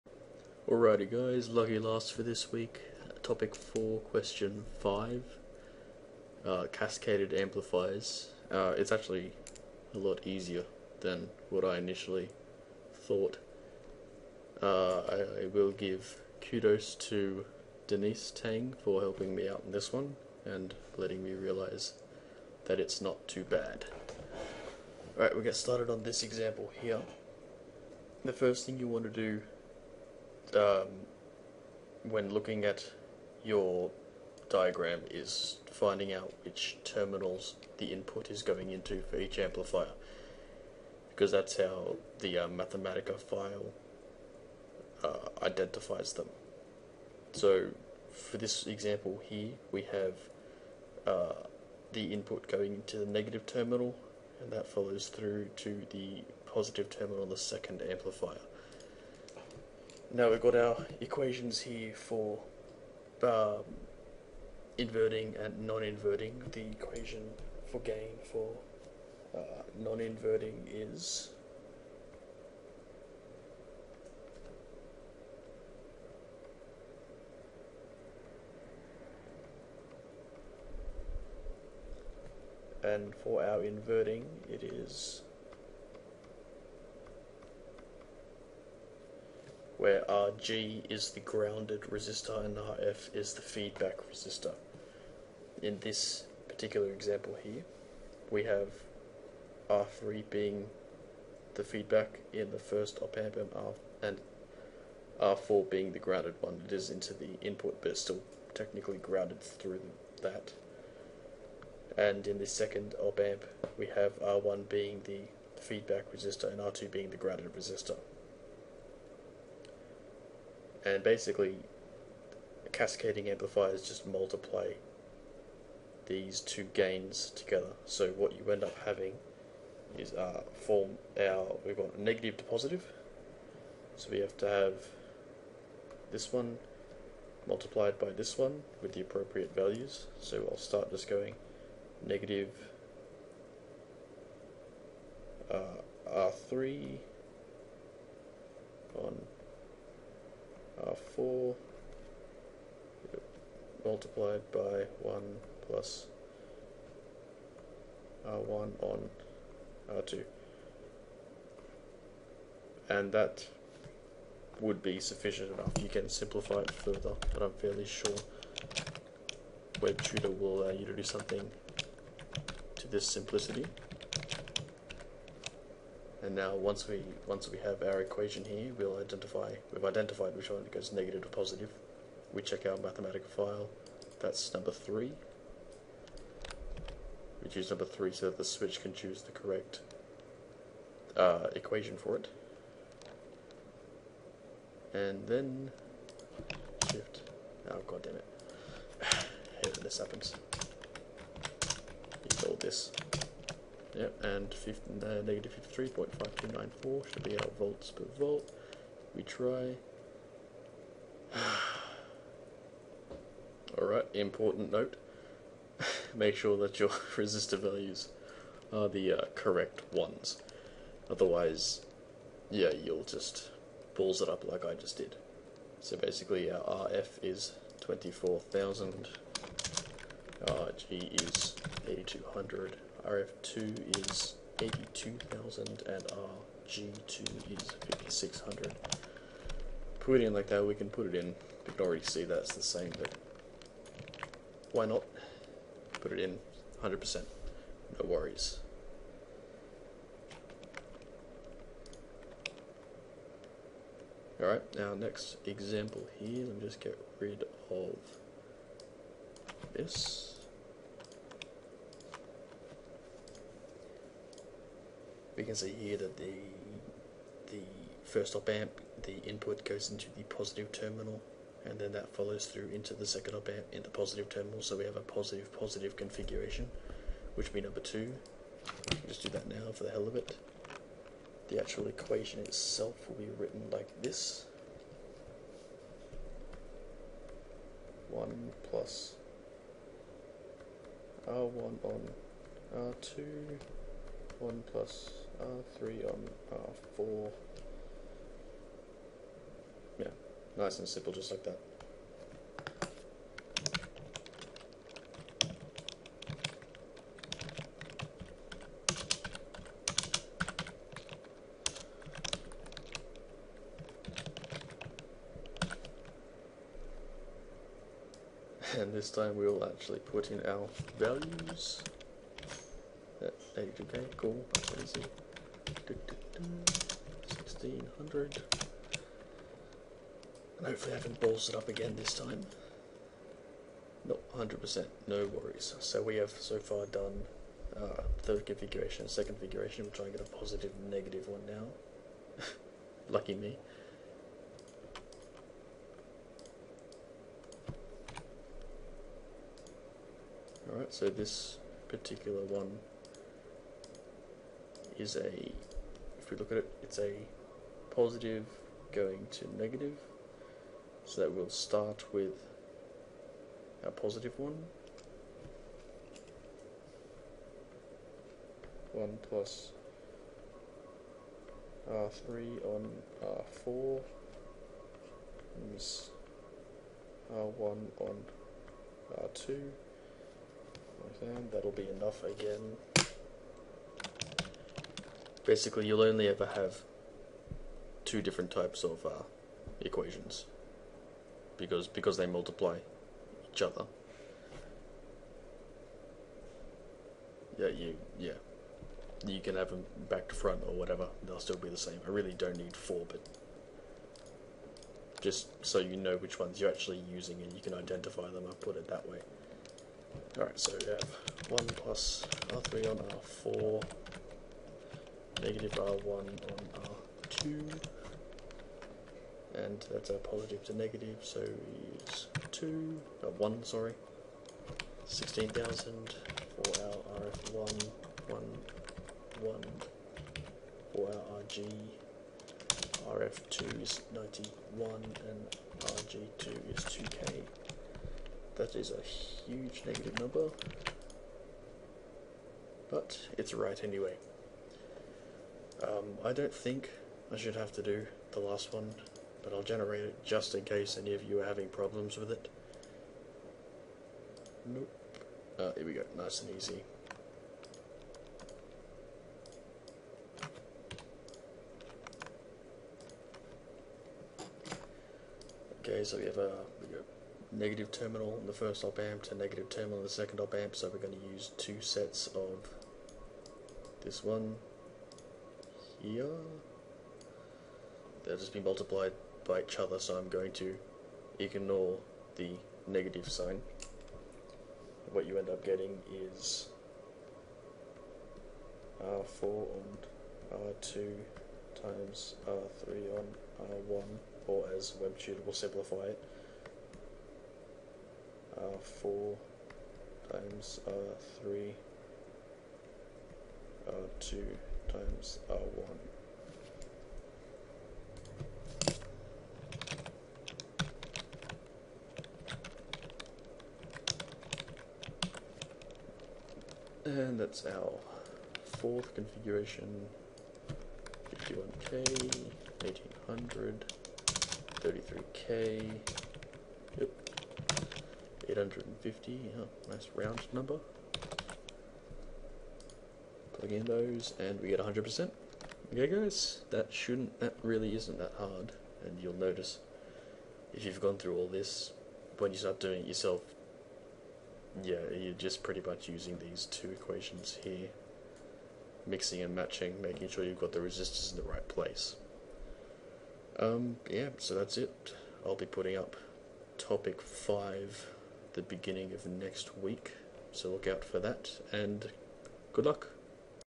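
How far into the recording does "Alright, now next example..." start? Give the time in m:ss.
4:14.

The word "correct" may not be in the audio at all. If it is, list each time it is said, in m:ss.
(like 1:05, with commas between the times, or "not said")
3:09, 3:39.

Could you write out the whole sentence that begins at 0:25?
Alright, we'll get started on this example here.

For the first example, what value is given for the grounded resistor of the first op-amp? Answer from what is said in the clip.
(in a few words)
8200.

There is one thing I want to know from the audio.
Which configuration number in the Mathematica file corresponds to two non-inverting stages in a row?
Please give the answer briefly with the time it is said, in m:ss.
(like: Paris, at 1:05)
2, at 4:37.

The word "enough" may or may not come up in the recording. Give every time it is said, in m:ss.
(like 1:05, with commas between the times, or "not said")
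2:45, 6:22.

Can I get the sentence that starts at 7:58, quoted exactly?
They'll just be multiplied by each other, so I'm going to ignore the negative sign.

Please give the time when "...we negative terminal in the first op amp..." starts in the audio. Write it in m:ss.
7:46.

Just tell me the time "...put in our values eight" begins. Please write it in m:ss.
5:19.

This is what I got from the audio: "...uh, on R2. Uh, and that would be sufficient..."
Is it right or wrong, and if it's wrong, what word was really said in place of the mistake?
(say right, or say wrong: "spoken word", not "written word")
right.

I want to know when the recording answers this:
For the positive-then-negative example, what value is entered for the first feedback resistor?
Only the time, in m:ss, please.
7:05.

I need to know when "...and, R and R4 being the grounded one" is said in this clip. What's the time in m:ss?
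1:43.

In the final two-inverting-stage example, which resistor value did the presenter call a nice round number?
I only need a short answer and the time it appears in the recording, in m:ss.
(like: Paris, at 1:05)
850, at 8:48.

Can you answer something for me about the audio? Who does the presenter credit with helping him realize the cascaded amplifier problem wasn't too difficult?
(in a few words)
Denise Tang.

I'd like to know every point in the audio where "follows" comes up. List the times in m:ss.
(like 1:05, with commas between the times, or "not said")
0:54, 4:32.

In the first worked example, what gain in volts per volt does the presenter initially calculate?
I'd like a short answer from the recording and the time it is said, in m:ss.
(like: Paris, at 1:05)
-53.5294, at 3:25.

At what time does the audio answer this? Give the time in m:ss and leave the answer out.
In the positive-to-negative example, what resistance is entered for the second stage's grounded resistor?
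7:16.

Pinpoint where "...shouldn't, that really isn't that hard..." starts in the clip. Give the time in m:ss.
8:56.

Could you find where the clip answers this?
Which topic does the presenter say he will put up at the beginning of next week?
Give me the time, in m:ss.
9:16.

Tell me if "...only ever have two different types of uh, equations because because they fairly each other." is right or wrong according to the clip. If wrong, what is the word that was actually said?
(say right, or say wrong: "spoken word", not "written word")
wrong: "multiply", not "fairly".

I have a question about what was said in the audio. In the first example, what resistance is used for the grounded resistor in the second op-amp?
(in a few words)
5,600.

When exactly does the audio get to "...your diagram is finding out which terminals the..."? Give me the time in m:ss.
0:33.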